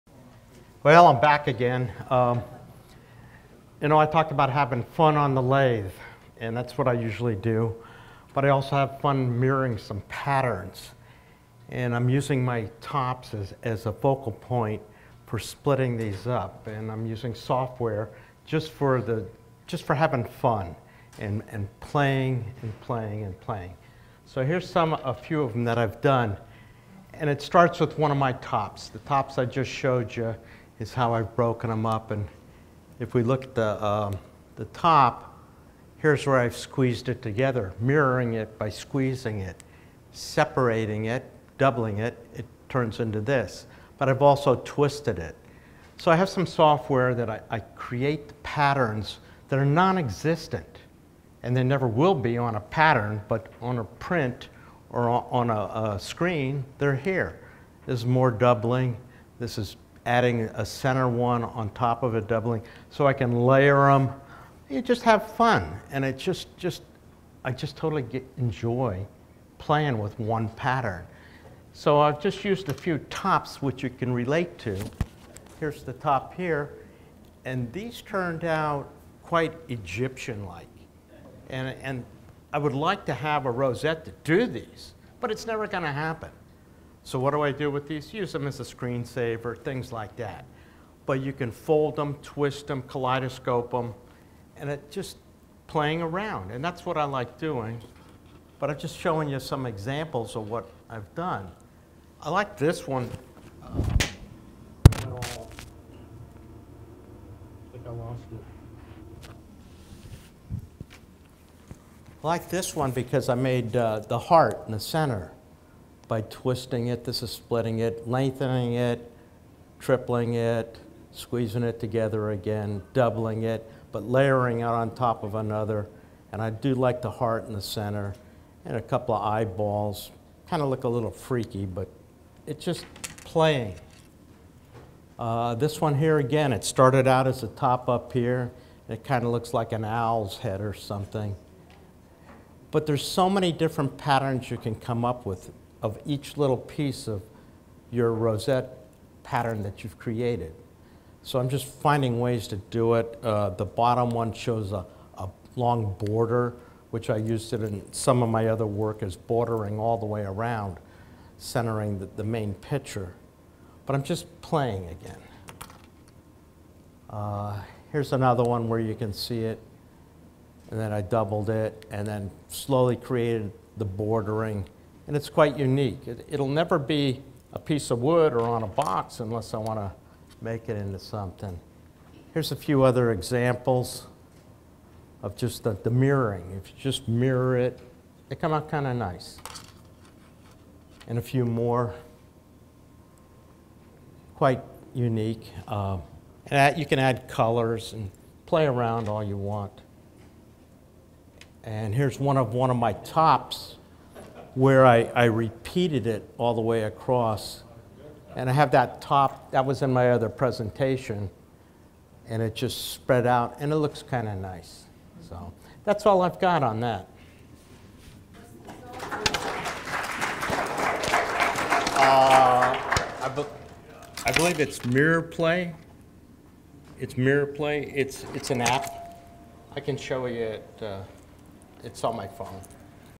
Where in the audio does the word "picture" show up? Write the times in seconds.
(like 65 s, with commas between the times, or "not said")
162 s.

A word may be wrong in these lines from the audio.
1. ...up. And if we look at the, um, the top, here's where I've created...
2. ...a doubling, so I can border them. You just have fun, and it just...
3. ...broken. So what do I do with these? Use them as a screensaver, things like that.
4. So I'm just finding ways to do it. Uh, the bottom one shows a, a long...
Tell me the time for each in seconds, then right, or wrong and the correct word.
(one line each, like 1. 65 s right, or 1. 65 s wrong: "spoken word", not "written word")
1. 31 s wrong: "squeezed", not "created"
2. 62 s wrong: "layer", not "border"
3. 85 s wrong: "happen", not "broken"
4. 151 s right.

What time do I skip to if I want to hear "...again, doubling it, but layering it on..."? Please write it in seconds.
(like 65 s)
122 s.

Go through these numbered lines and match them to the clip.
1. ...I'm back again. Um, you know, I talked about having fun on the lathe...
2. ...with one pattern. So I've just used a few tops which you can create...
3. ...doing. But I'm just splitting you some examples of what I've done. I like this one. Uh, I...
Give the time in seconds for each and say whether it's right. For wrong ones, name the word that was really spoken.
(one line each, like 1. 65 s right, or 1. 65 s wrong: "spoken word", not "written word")
1. 1 s right
2. 69 s wrong: "relate", not "create"
3. 97 s wrong: "showing", not "splitting".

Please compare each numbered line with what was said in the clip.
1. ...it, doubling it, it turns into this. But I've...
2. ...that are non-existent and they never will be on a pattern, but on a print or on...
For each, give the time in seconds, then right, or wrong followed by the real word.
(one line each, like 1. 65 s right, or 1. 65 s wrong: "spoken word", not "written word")
1. 41 s right
2. 49 s right.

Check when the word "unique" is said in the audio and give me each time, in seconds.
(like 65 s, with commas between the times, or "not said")
175 s, 194 s.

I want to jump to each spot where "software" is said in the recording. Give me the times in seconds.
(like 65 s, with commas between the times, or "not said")
17 s, 46 s.